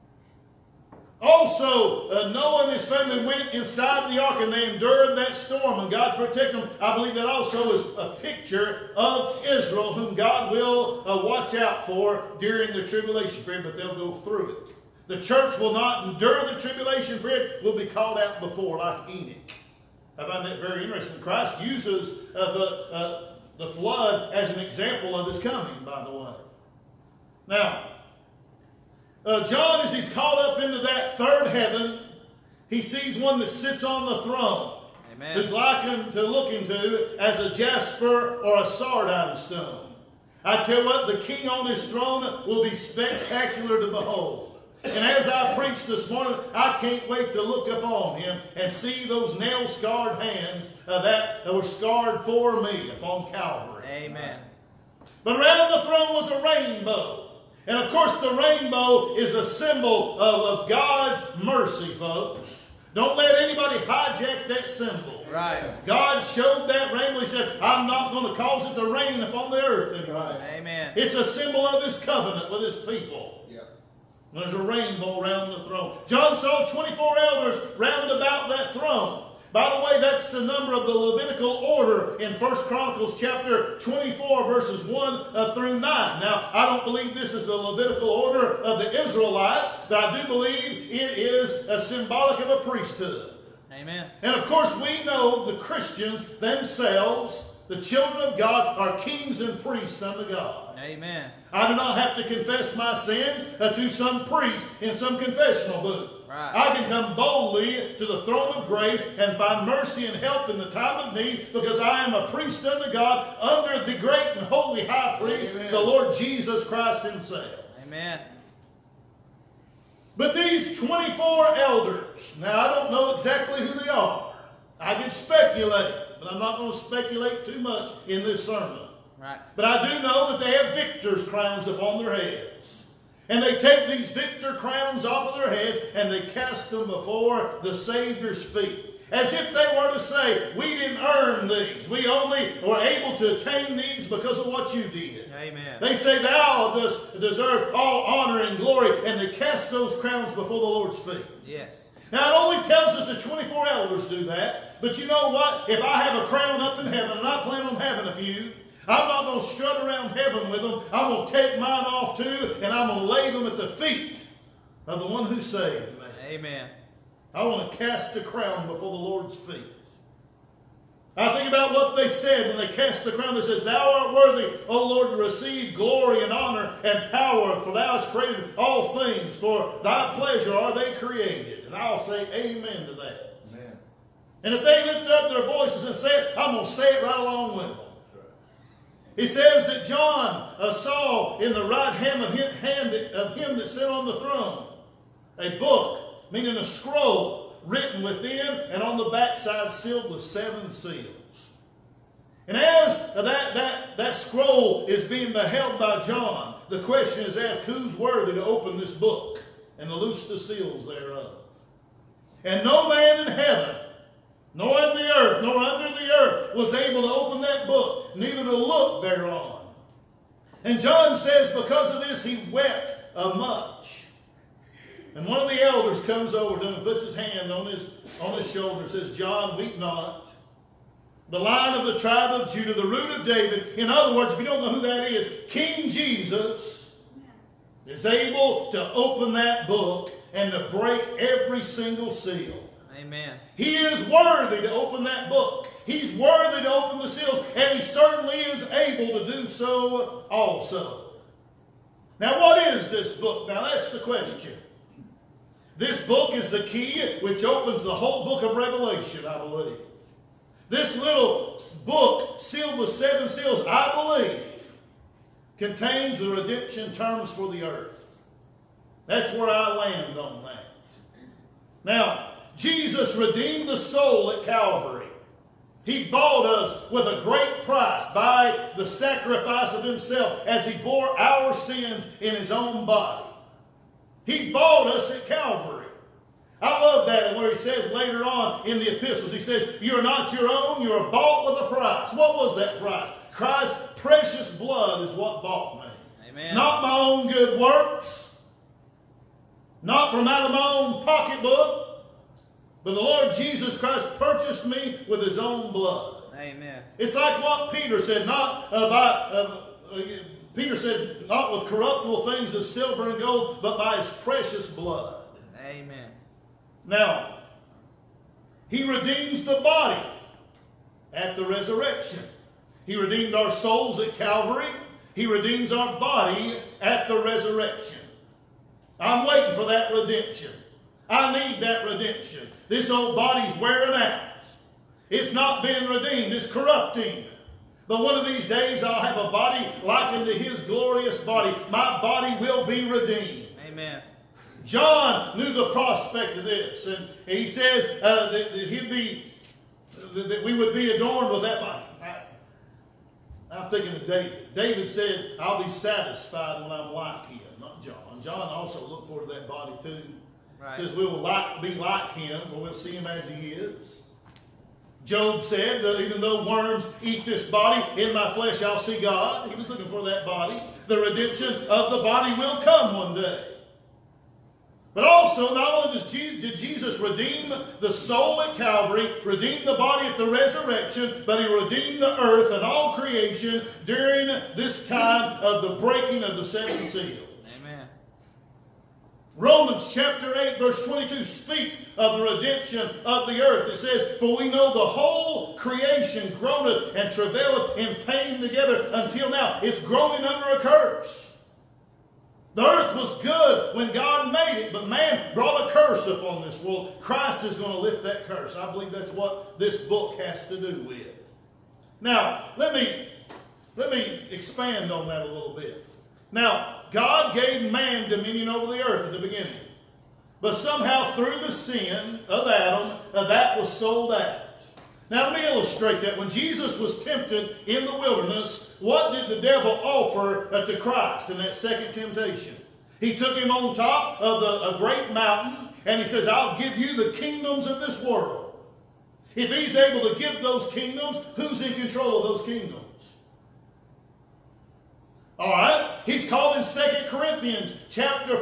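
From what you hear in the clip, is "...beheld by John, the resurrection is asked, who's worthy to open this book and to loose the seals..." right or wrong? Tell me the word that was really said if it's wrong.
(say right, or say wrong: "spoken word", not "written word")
wrong: "question", not "resurrection".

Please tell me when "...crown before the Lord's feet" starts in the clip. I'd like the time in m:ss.
2:48.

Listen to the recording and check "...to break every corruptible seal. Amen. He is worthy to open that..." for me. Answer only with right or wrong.
wrong.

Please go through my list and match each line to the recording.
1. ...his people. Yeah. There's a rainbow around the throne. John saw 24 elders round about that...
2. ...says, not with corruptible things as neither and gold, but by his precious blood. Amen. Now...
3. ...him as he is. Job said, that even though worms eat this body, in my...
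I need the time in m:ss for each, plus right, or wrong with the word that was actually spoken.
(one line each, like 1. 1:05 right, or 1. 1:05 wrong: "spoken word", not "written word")
1. 1:12 right
2. 5:10 wrong: "silver", not "neither"
3. 6:02 right.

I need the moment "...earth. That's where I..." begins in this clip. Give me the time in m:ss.
4:27.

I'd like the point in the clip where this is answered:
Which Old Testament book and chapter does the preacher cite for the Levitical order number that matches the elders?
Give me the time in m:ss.
1:22.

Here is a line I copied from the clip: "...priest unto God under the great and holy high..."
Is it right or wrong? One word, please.
right.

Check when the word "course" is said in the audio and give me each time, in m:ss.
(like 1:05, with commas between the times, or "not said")
0:57, 1:34.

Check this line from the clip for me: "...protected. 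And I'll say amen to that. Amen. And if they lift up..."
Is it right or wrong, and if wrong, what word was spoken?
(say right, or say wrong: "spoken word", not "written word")
wrong: "created", not "protected".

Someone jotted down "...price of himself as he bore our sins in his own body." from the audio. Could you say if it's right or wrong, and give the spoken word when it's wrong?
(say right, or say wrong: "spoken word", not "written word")
wrong: "sacrifice", not "price".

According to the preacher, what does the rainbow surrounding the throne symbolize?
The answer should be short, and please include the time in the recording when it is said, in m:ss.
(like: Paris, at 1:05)
God's mercy, at 1:00.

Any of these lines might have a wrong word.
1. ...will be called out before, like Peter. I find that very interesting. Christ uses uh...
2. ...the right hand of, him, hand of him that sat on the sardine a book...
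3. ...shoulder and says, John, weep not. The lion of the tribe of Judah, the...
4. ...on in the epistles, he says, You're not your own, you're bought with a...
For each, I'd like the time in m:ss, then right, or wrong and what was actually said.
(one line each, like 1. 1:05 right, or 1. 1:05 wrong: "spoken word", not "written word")
1. 0:17 wrong: "Enoch", not "Peter"
2. 3:11 wrong: "throne", not "sardine"
3. 3:48 right
4. 4:48 right.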